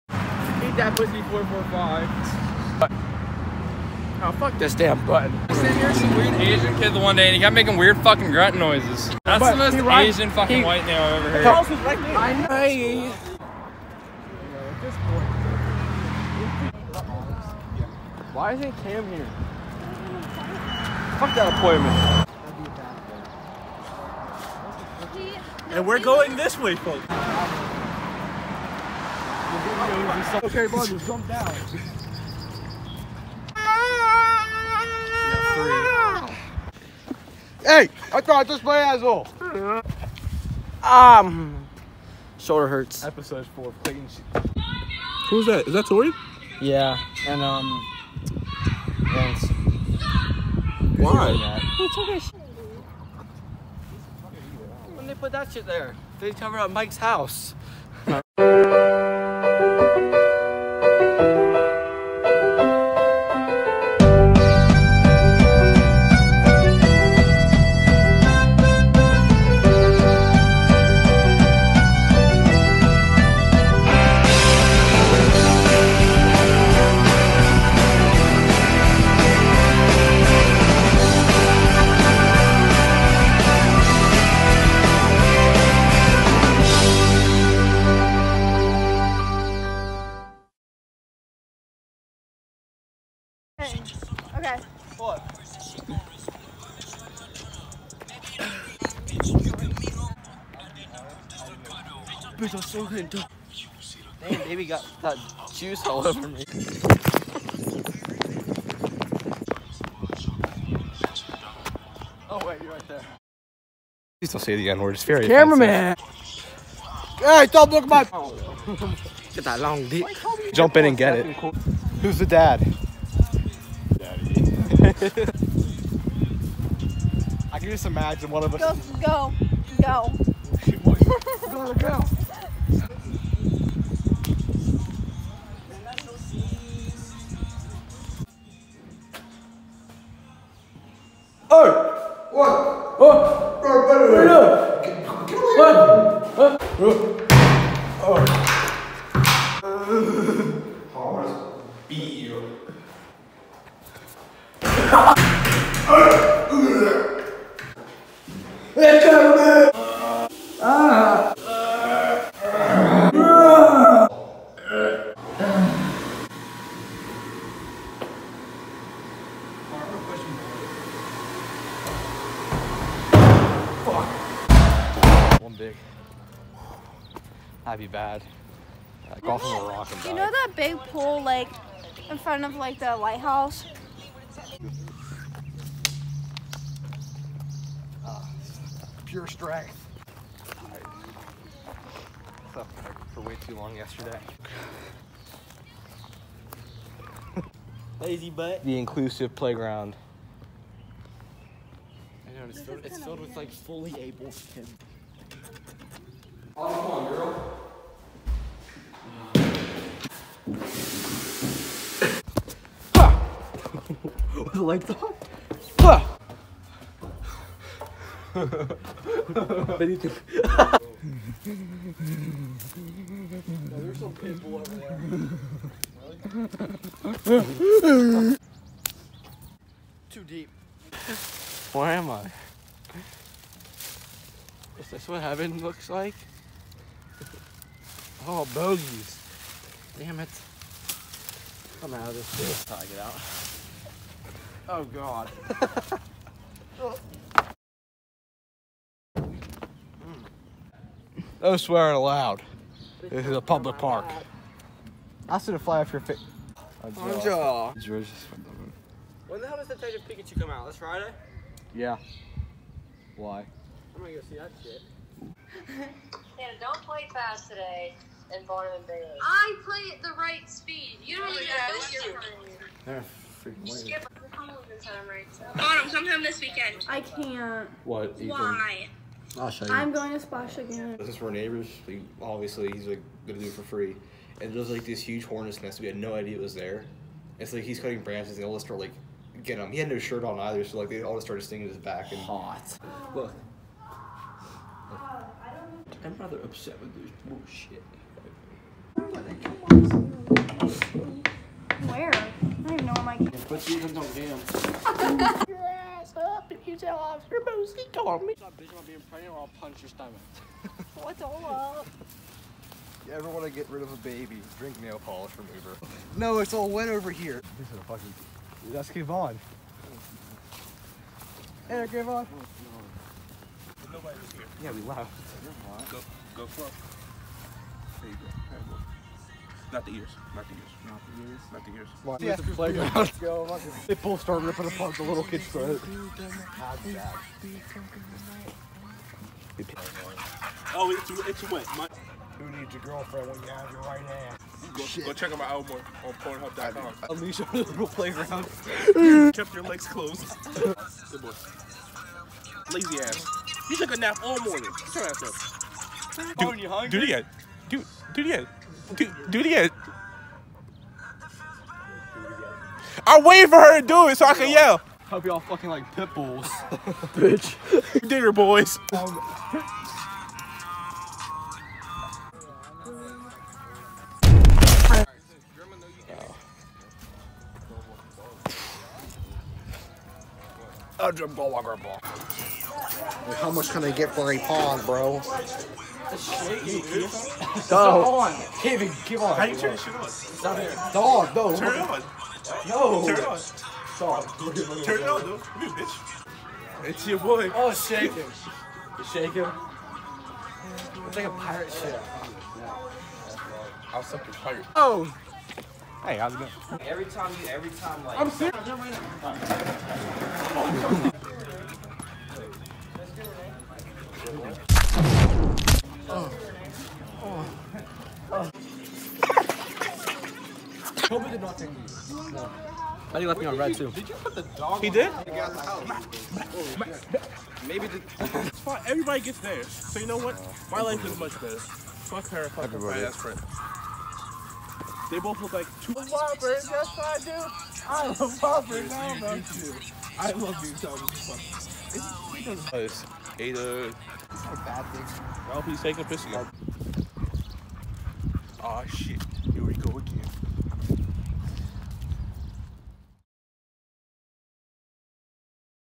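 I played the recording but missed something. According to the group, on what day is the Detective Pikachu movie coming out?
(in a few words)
This Friday.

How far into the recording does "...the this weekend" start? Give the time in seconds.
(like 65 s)
274 s.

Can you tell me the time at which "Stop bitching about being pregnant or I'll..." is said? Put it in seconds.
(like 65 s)
308 s.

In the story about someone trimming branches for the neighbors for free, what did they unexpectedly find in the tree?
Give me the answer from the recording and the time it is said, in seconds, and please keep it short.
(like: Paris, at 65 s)
Hornet's nest, at 285 s.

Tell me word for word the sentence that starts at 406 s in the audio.
Every time you, every time like.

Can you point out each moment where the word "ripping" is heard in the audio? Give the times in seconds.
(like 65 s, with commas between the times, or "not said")
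334 s.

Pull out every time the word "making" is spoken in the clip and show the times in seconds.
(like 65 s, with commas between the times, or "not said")
7 s.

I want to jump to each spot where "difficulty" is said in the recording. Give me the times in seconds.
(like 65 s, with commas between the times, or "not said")
not said.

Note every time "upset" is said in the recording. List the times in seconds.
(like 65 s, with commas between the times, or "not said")
296 s.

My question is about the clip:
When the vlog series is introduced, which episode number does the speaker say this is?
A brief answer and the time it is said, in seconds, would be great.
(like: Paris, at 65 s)
4, at 43 s.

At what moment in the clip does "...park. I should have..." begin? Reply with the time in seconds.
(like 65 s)
253 s.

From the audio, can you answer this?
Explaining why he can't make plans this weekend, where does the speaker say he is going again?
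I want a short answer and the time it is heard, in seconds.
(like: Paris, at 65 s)
Splash, at 280 s.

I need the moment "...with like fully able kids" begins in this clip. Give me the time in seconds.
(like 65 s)
203 s.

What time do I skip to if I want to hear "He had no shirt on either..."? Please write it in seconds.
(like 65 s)
289 s.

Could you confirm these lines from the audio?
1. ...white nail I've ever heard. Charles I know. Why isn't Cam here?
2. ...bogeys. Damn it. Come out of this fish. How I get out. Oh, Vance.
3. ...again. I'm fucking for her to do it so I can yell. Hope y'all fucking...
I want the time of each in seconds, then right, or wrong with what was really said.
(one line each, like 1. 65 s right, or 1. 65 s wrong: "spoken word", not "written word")
1. 10 s right
2. 238 s wrong: "God", not "Vance"
3. 359 s wrong: "waiting", not "fucking".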